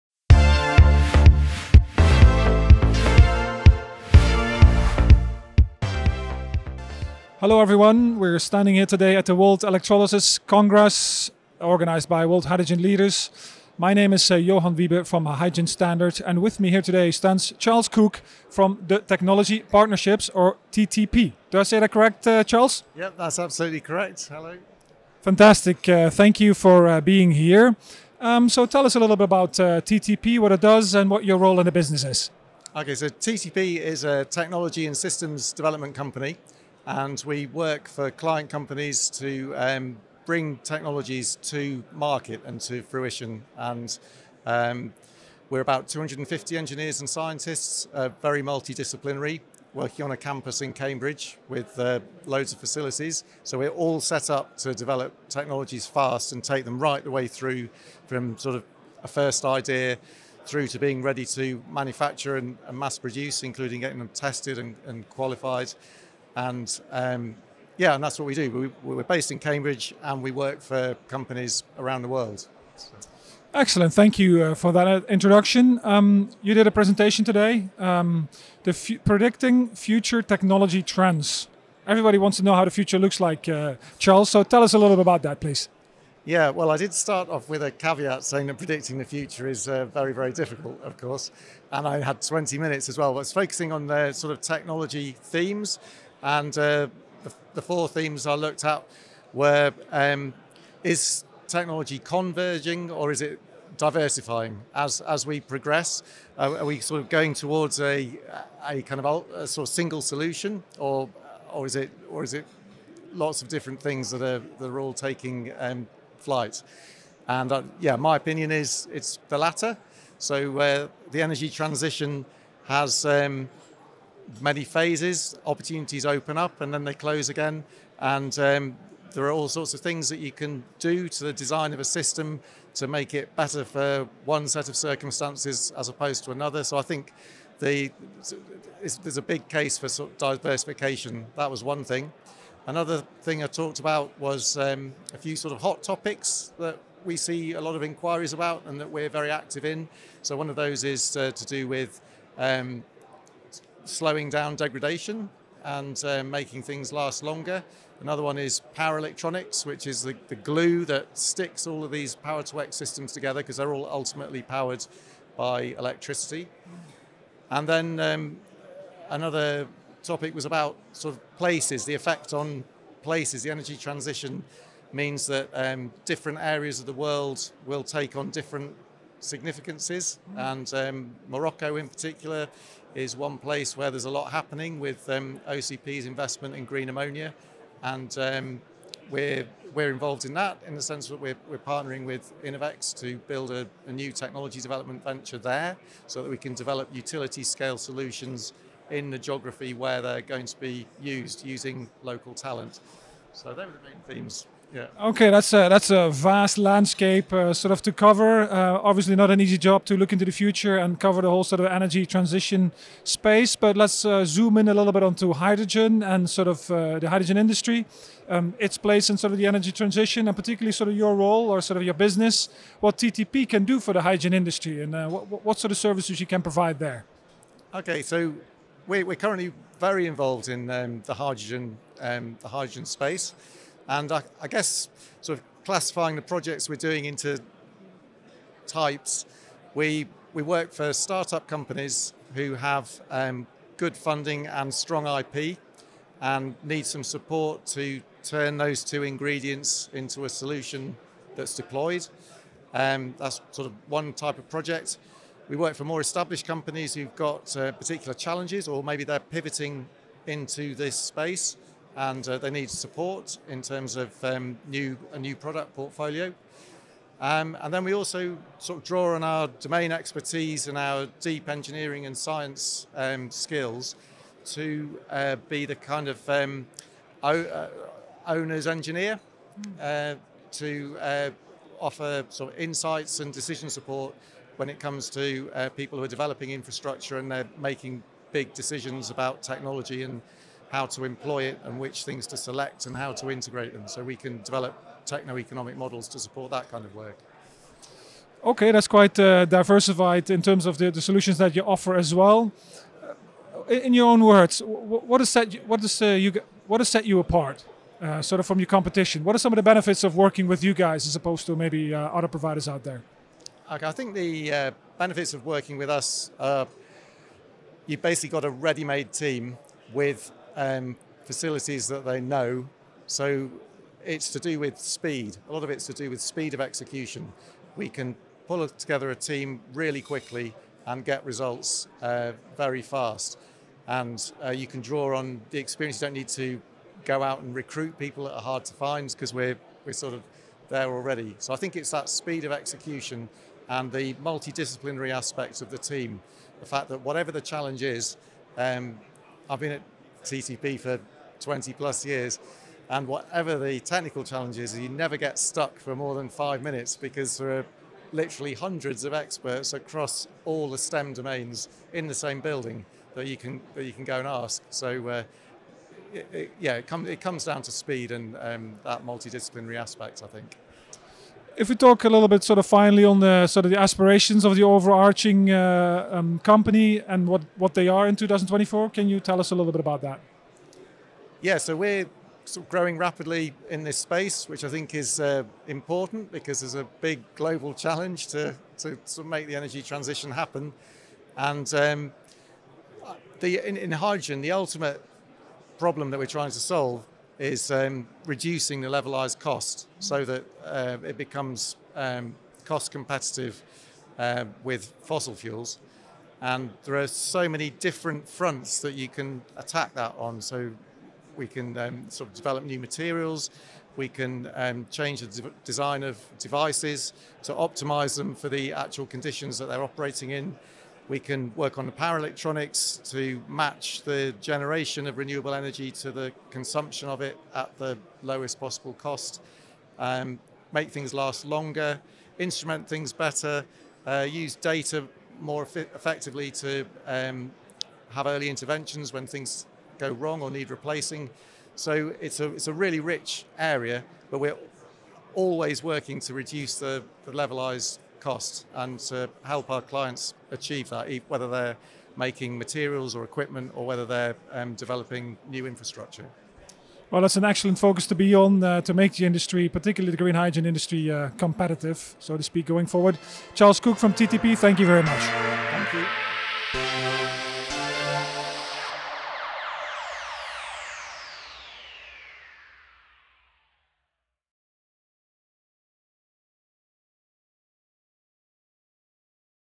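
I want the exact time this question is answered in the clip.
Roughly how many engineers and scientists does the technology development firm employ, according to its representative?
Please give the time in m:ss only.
0:45.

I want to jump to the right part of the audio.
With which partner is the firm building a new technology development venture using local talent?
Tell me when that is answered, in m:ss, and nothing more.
3:12.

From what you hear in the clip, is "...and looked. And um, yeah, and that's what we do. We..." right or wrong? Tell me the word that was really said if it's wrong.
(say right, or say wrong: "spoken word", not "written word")
wrong: "qualified", not "looked".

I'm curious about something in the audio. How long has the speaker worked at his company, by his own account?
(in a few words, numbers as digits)
20 plus years.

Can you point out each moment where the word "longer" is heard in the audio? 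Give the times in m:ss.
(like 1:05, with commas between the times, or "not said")
2:37, 7:11.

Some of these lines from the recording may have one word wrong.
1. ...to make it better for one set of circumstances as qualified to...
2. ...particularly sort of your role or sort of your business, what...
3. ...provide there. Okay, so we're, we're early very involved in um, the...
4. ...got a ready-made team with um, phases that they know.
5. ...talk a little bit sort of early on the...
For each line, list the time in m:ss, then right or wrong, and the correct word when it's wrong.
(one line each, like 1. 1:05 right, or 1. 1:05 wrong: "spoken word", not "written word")
1. 2:12 wrong: "opposed", not "qualified"
2. 3:40 right
3. 3:46 wrong: "currently", not "early"
4. 5:18 wrong: "facilities", not "phases"
5. 6:11 wrong: "finally", not "early".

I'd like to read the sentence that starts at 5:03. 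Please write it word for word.
Uh, in your own words, what is that?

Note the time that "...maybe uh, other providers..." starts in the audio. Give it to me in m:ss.
5:11.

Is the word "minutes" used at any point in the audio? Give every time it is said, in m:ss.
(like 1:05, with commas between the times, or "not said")
1:32, 5:56.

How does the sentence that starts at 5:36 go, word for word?
You don't need to go out and recruit people that are hard to find because we're, we're sort of there already.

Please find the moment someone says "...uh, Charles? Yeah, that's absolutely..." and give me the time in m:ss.
0:22.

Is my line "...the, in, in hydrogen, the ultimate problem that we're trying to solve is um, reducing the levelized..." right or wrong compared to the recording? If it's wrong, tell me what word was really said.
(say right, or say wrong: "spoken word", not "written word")
right.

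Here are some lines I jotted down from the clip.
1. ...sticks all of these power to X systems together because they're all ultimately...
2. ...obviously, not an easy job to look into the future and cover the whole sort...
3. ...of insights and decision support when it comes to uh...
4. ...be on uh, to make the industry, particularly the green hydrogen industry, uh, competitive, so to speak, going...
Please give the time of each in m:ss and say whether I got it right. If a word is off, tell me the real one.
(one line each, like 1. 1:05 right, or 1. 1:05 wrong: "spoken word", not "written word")
1. 2:41 right
2. 3:28 right
3. 4:42 right
4. 7:38 right.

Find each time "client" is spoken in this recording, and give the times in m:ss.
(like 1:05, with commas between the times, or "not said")
0:38, 7:29.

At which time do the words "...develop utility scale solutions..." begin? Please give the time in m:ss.
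3:16.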